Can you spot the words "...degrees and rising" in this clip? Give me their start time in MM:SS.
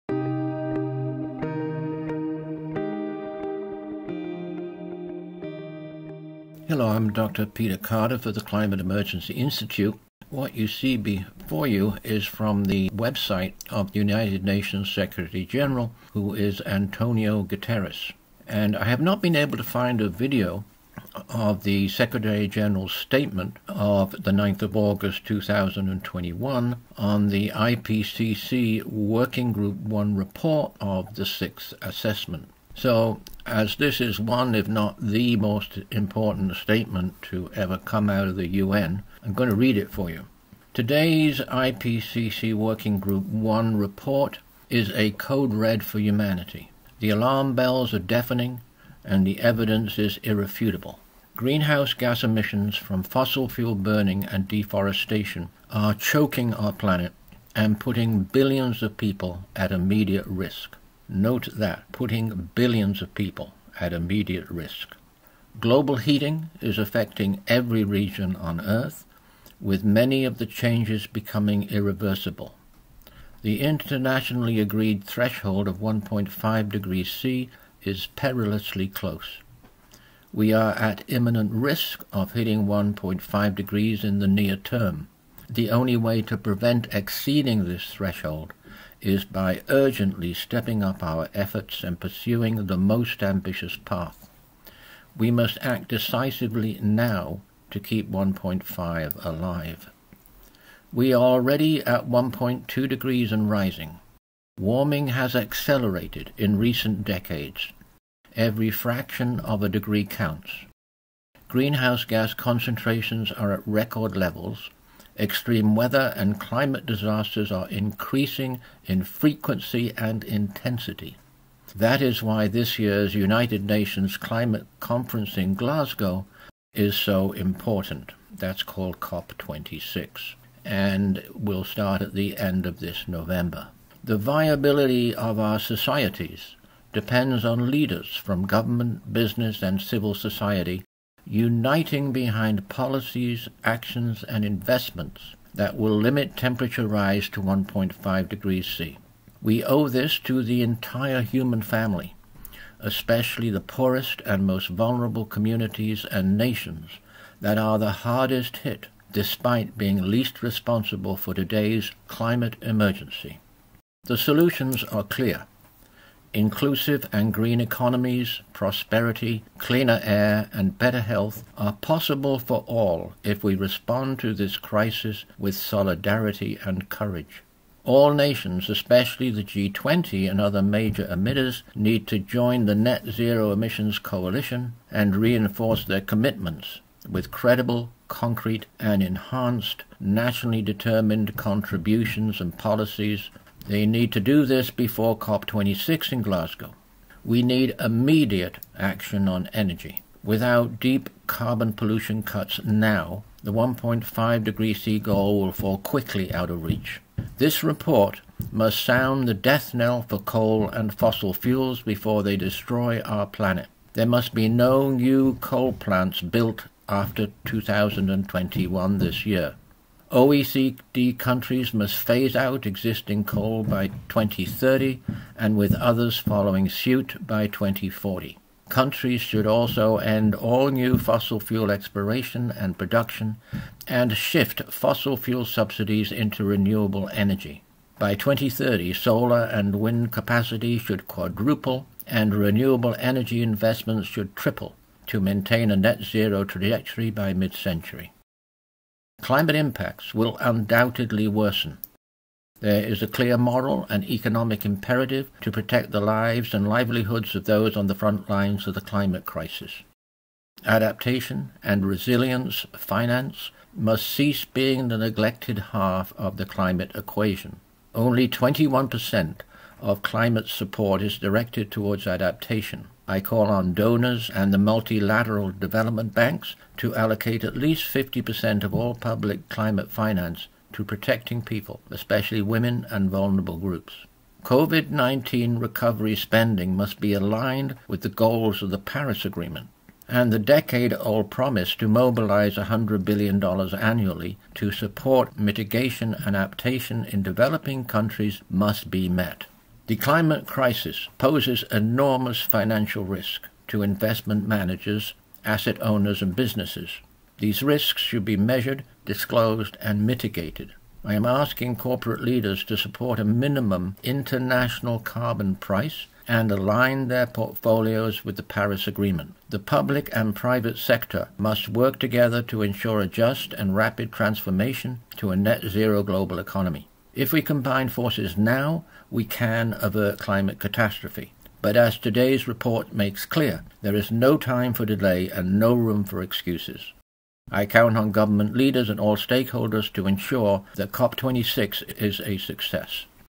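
01:42.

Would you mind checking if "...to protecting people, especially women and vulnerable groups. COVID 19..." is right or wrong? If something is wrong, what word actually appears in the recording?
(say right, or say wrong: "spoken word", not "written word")
right.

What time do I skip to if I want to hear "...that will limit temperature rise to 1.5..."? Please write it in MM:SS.
02:25.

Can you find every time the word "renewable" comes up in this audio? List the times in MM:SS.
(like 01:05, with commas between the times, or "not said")
03:56, 04:02.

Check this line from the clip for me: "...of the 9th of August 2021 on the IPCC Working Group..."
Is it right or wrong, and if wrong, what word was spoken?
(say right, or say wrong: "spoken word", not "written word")
right.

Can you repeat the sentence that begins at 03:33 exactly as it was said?
There must be no new coal plants built after 2021 this year.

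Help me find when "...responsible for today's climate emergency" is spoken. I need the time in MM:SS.
02:40.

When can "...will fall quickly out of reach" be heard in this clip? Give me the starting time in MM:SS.
03:25.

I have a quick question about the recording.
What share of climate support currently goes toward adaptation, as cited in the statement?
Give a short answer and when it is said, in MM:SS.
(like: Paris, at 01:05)
21%, at 04:28.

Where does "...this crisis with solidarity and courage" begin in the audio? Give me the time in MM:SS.
02:54.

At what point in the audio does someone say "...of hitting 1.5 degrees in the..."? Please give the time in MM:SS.
01:22.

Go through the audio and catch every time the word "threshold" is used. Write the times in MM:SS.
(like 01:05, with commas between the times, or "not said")
01:15, 01:27.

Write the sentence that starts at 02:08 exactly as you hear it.
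That's called COP26 and will start at the end of this November.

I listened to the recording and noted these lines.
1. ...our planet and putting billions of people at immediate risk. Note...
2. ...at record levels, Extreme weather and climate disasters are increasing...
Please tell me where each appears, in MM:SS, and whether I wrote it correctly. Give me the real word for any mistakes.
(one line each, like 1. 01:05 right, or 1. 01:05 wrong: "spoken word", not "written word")
1. 00:56 right
2. 01:53 right.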